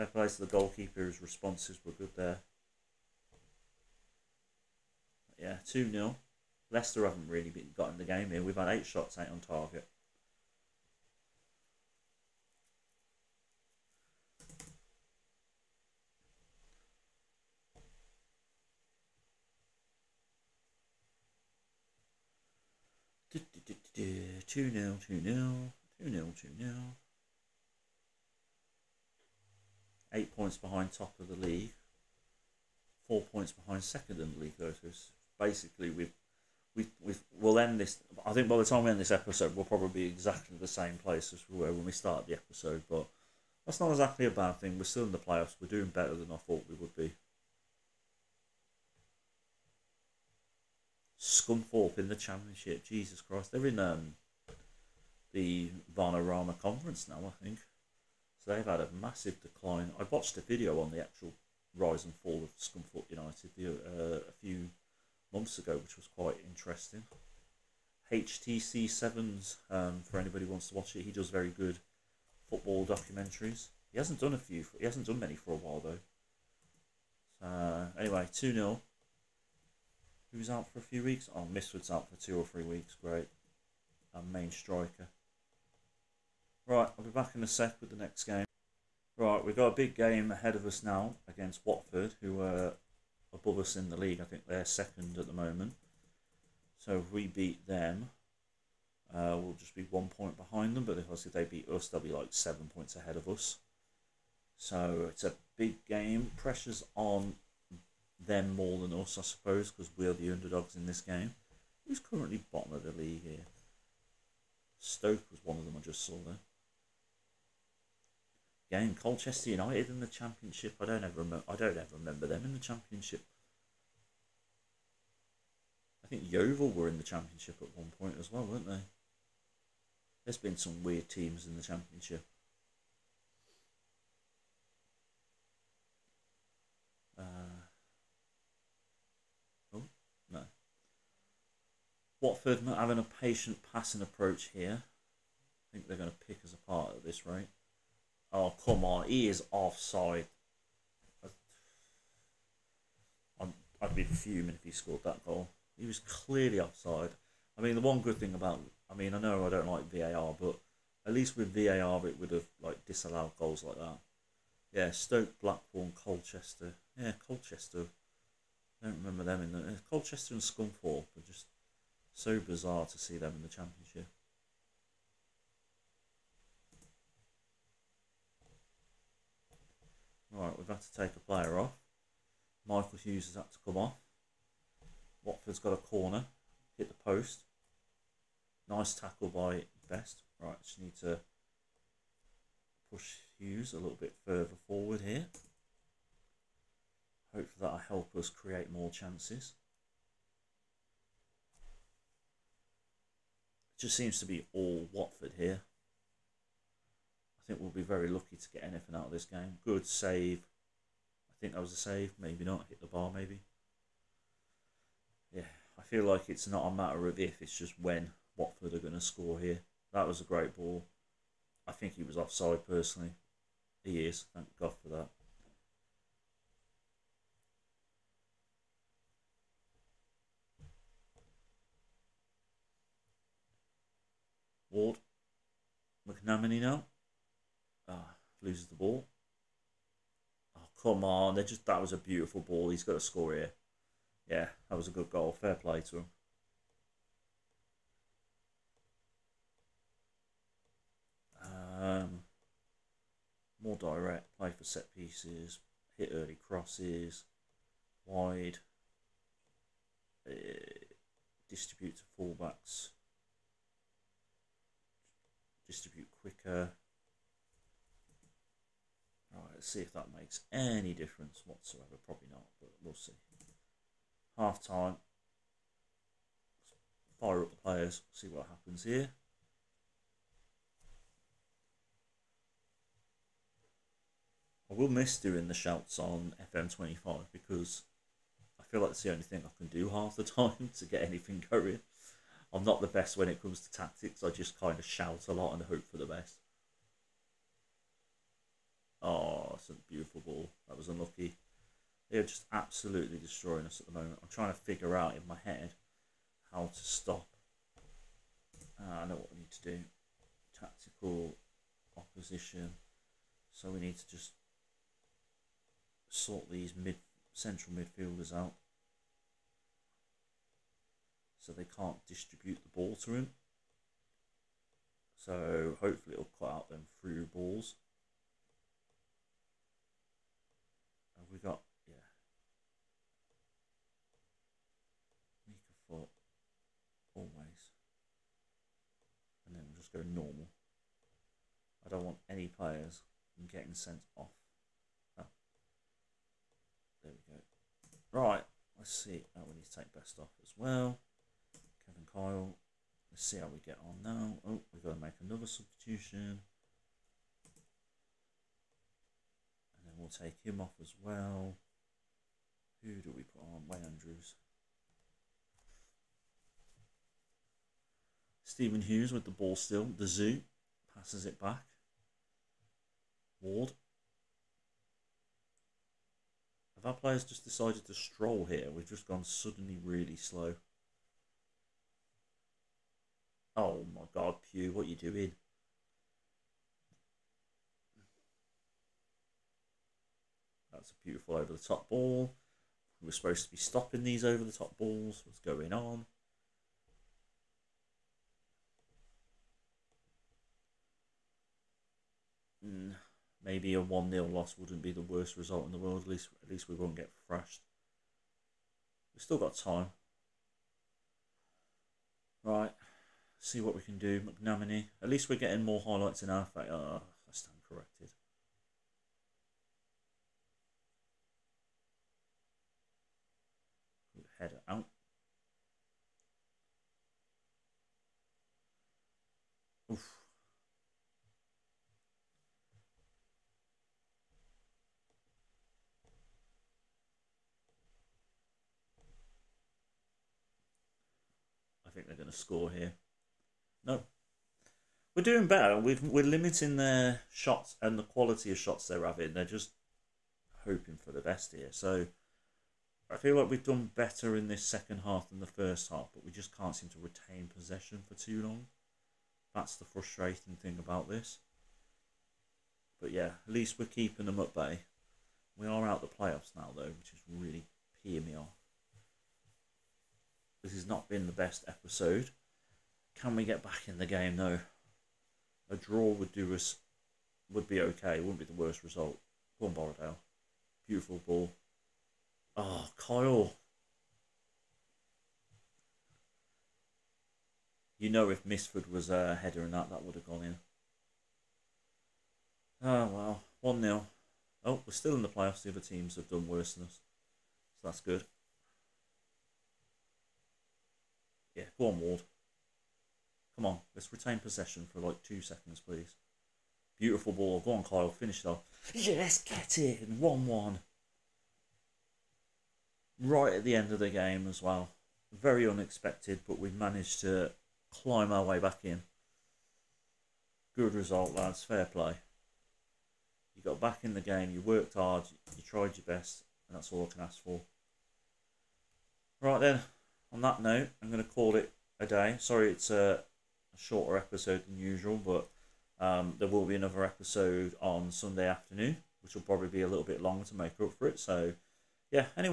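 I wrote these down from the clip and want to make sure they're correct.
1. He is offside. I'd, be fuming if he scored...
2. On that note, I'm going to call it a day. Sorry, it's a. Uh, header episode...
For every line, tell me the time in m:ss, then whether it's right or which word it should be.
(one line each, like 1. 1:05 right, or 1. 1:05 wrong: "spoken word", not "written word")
1. 2:29 right
2. 8:50 wrong: "shorter", not "header".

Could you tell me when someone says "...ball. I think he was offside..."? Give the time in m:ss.
3:40.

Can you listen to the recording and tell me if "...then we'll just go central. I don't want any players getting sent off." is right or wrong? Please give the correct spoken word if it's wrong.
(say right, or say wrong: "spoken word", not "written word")
wrong: "normal", not "central".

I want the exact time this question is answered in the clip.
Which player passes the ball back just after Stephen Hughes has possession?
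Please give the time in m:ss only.
6:09.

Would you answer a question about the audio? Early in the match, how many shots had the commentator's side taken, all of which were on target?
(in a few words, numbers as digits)
8.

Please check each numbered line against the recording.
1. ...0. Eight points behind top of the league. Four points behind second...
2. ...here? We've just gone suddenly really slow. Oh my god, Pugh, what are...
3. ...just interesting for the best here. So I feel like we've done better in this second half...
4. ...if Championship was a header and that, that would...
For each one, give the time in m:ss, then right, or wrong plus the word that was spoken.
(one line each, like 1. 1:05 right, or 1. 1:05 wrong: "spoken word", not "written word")
1. 0:26 right
2. 6:18 right
3. 7:29 wrong: "hoping", not "interesting"
4. 8:08 wrong: "Mifsud", not "Championship".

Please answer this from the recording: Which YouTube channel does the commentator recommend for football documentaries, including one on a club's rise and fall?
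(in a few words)
HITC Sevens.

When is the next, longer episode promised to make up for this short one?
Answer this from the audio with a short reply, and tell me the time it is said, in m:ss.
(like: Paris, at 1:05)
Sunday afternoon, at 8:58.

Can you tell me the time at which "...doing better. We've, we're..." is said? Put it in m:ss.
7:25.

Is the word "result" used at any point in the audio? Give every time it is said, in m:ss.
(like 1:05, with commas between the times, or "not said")
6:45, 7:58, 8:40.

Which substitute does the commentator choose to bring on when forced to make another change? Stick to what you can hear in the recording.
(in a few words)
Wayne Andrews.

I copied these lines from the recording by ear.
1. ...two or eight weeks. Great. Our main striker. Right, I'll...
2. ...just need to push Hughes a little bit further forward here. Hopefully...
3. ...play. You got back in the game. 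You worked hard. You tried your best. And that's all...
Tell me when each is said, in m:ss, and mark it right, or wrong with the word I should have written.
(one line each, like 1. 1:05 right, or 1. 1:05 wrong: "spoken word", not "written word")
1. 1:22 wrong: "three", not "eight"
2. 3:10 right
3. 8:41 right.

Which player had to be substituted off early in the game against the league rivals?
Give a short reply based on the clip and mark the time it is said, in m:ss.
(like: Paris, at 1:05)
Michael Hughes, at 3:02.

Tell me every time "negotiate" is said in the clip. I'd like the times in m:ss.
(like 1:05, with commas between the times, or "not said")
not said.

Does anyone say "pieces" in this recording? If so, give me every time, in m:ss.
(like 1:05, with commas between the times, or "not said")
4:14.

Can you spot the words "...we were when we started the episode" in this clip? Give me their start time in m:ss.
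0:41.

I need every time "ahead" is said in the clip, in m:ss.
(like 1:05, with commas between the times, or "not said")
1:30, 1:42.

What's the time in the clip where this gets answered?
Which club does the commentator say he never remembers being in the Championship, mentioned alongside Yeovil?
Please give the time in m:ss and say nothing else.
1:58.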